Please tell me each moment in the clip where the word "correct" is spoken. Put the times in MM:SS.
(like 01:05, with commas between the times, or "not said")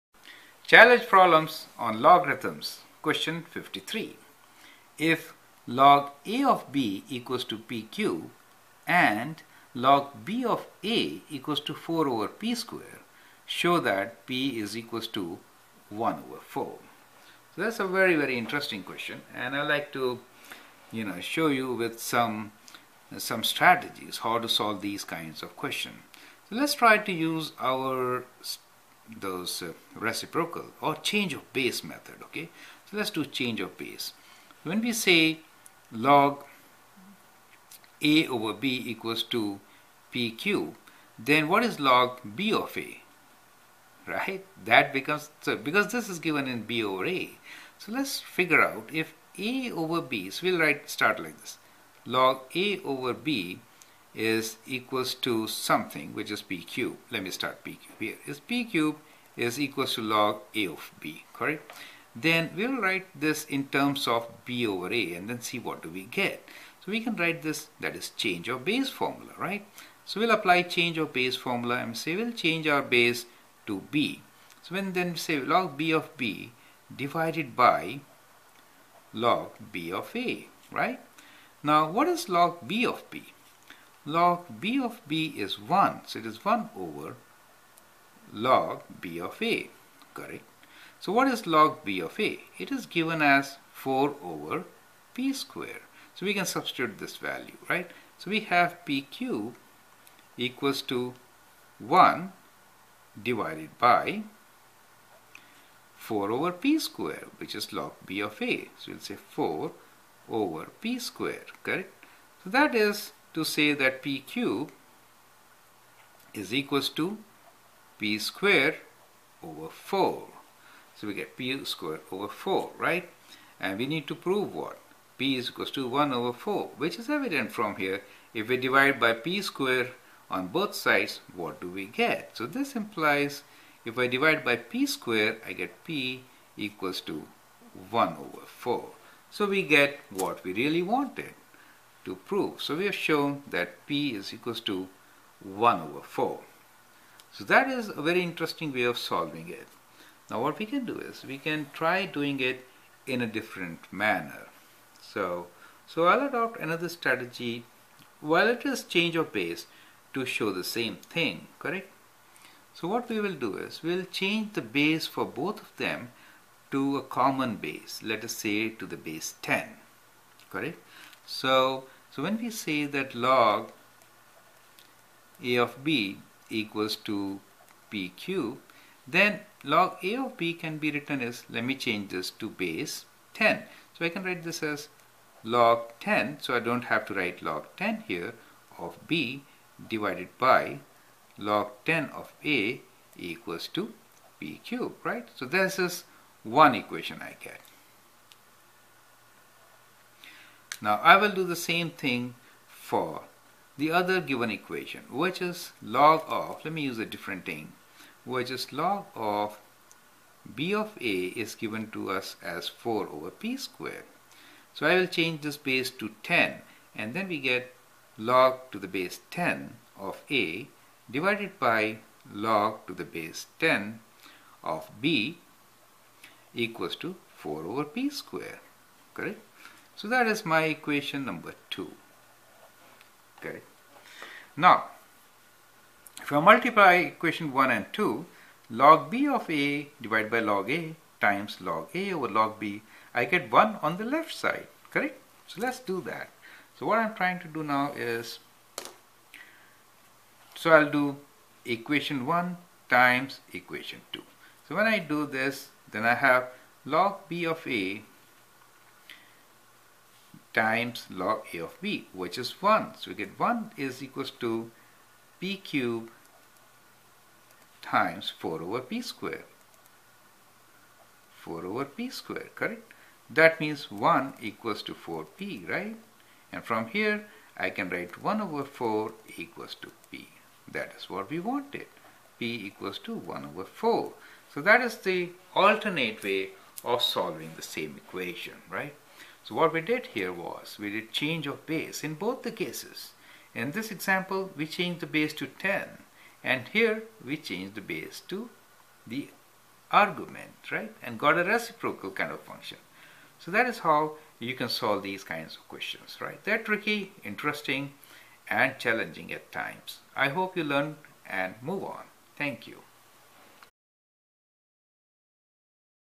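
01:01, 01:30, 01:51, 02:41, 02:50, 03:49, 04:04, 04:32.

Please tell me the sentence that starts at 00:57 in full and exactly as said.
Let me start p cubed here.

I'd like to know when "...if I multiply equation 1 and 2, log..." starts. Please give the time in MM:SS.
03:56.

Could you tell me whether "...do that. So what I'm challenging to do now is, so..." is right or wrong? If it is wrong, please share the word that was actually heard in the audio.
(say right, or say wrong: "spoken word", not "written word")
wrong: "trying", not "challenging".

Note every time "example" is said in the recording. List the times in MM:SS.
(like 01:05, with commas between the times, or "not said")
04:53.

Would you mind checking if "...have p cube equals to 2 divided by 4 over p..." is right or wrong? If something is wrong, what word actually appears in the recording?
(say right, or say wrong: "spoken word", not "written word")
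wrong: "1", not "2".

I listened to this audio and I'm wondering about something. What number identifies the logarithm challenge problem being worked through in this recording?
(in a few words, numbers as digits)
53.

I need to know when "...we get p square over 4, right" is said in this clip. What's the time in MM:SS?
02:01.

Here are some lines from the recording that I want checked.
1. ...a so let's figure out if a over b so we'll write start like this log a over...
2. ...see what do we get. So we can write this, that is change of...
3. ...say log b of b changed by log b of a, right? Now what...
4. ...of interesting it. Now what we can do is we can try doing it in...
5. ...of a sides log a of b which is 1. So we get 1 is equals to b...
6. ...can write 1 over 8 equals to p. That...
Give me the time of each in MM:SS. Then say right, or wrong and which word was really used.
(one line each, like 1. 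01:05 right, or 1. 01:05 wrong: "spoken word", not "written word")
1. 00:47 right
2. 01:05 right
3. 01:15 wrong: "divided", not "changed"
4. 02:28 wrong: "solving", not "interesting"
5. 04:17 wrong: "times", not "sides"
6. 04:37 wrong: "4", not "8".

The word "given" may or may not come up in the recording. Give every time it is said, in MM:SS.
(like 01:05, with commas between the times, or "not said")
00:46, 01:32, 03:24, 03:31.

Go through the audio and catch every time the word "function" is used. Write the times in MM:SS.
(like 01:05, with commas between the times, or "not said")
05:02.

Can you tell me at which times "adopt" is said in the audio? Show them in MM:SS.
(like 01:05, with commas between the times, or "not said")
02:36.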